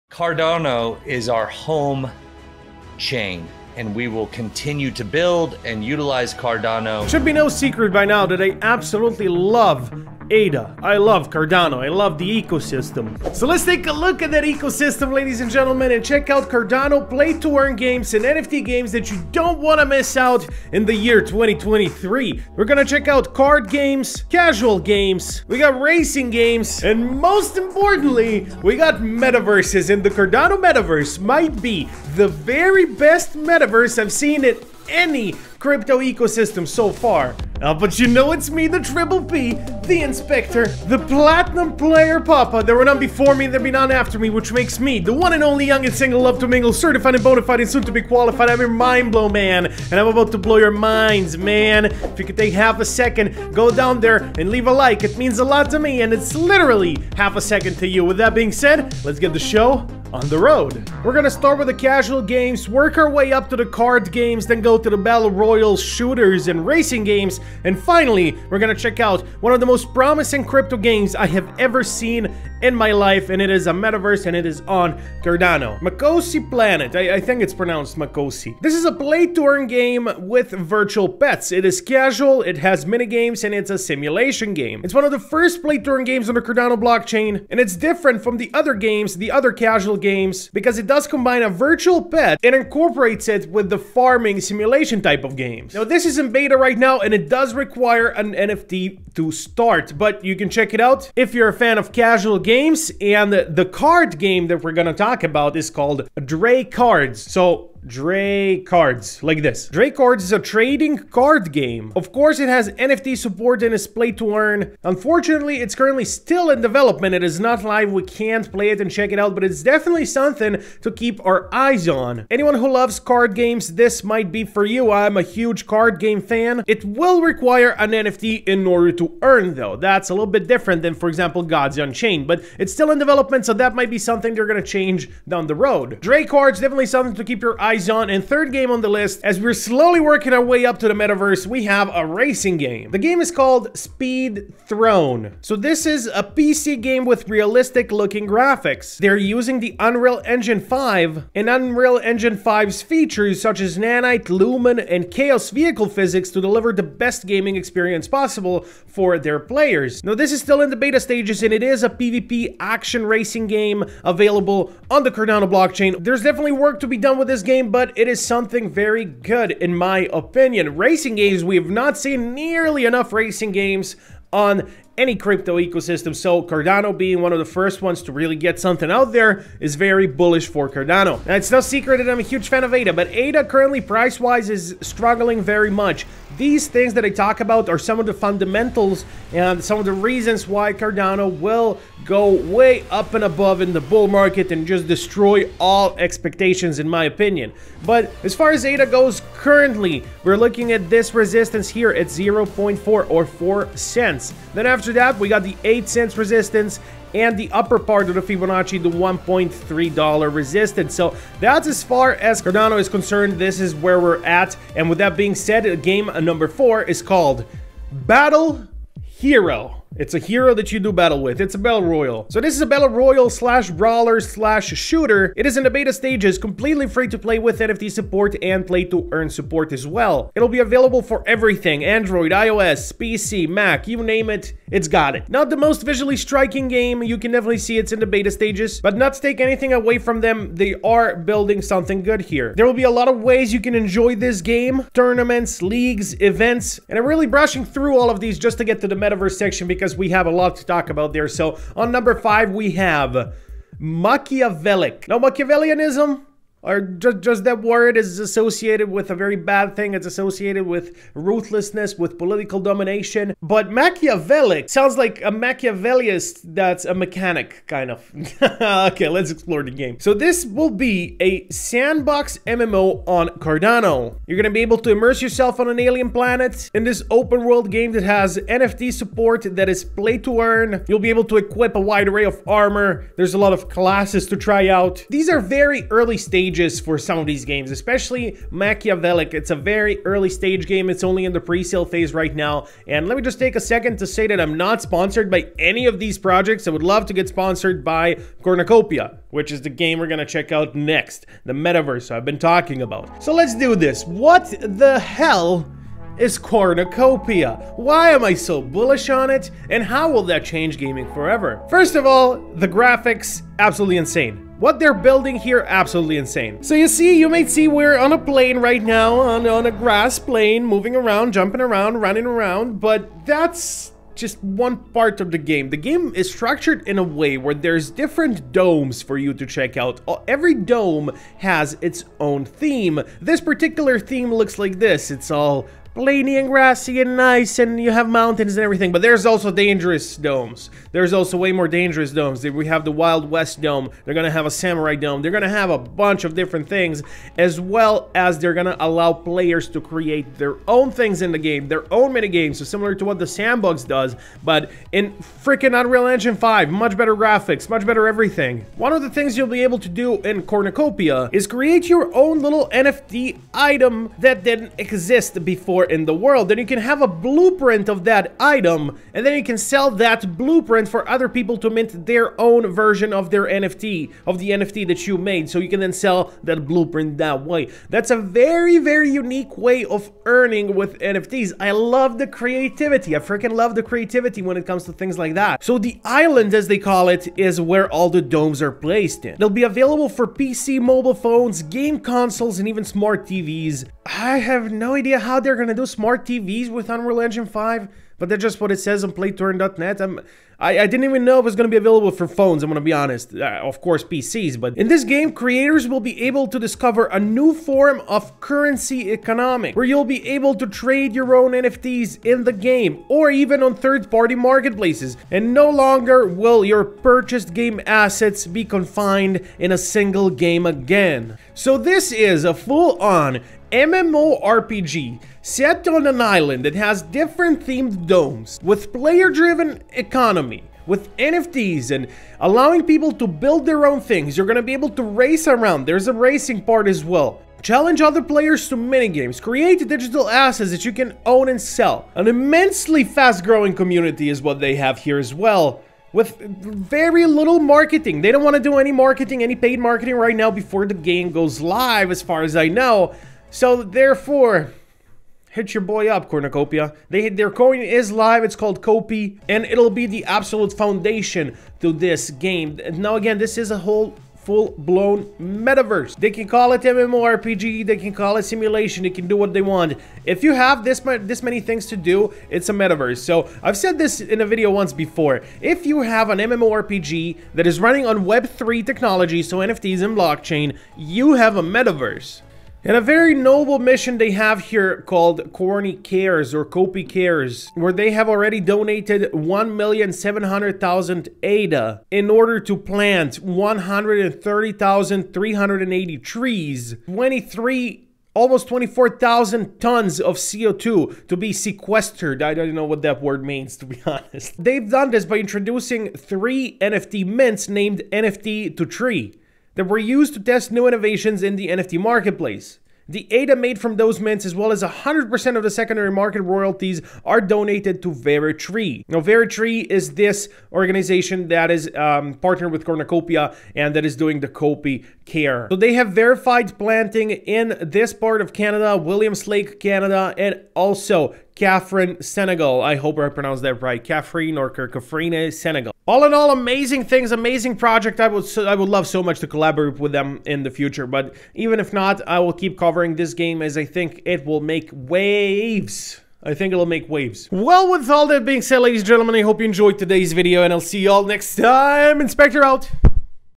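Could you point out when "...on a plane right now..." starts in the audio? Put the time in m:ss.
5:17.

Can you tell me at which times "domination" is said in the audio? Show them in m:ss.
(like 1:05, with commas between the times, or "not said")
4:22.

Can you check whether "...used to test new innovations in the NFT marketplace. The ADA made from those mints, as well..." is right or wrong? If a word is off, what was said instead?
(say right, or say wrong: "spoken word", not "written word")
right.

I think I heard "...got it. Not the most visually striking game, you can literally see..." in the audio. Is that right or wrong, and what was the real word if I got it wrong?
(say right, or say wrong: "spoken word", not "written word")
wrong: "definitely", not "literally".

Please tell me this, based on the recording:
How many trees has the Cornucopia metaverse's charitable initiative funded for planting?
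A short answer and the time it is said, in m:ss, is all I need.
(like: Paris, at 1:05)
130,380, at 8:13.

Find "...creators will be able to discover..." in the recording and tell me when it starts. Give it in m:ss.
6:45.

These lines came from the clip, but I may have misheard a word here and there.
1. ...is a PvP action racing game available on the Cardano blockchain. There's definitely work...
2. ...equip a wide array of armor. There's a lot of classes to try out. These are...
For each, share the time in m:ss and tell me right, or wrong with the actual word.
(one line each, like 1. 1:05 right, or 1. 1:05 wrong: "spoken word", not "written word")
1. 2:41 right
2. 4:41 right.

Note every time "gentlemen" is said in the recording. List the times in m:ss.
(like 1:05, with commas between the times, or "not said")
0:15, 9:09.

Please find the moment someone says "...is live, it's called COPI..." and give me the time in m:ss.
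7:37.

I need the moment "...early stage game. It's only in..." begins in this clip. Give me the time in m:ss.
4:50.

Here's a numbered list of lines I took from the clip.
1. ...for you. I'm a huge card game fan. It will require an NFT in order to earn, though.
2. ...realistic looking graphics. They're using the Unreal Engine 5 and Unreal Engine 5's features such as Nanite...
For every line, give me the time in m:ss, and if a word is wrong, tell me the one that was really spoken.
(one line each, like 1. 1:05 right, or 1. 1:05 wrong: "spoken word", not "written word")
1. 2:04 right
2. 2:27 right.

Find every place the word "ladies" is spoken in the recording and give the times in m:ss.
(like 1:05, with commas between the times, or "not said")
0:15, 9:08.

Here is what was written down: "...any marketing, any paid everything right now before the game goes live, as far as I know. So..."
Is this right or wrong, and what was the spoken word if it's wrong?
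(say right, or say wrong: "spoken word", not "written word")
wrong: "marketing", not "everything".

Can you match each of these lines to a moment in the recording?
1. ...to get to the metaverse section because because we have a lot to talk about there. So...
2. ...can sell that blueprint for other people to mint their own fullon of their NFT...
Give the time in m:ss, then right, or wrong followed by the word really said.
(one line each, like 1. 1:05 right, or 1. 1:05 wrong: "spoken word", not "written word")
1. 4:08 right
2. 6:09 wrong: "version", not "fullon".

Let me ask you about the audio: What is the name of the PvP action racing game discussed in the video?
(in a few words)
Speed Throne.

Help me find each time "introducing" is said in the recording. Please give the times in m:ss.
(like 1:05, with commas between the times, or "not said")
8:25.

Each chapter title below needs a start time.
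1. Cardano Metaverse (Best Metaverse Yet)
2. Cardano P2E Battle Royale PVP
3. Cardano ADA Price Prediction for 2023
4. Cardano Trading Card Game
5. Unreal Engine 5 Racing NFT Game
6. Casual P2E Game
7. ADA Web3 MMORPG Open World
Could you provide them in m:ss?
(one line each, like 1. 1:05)
1. 4:58
2. 3:32
3. 3:01
4. 1:42
5. 2:15
6. 1:15
7. 4:11.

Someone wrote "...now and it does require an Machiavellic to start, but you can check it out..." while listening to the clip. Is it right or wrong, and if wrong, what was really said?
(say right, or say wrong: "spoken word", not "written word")
wrong: "NFT", not "Machiavellic".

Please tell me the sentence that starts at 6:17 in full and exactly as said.
That's a very, very unique way of earning with NFTs.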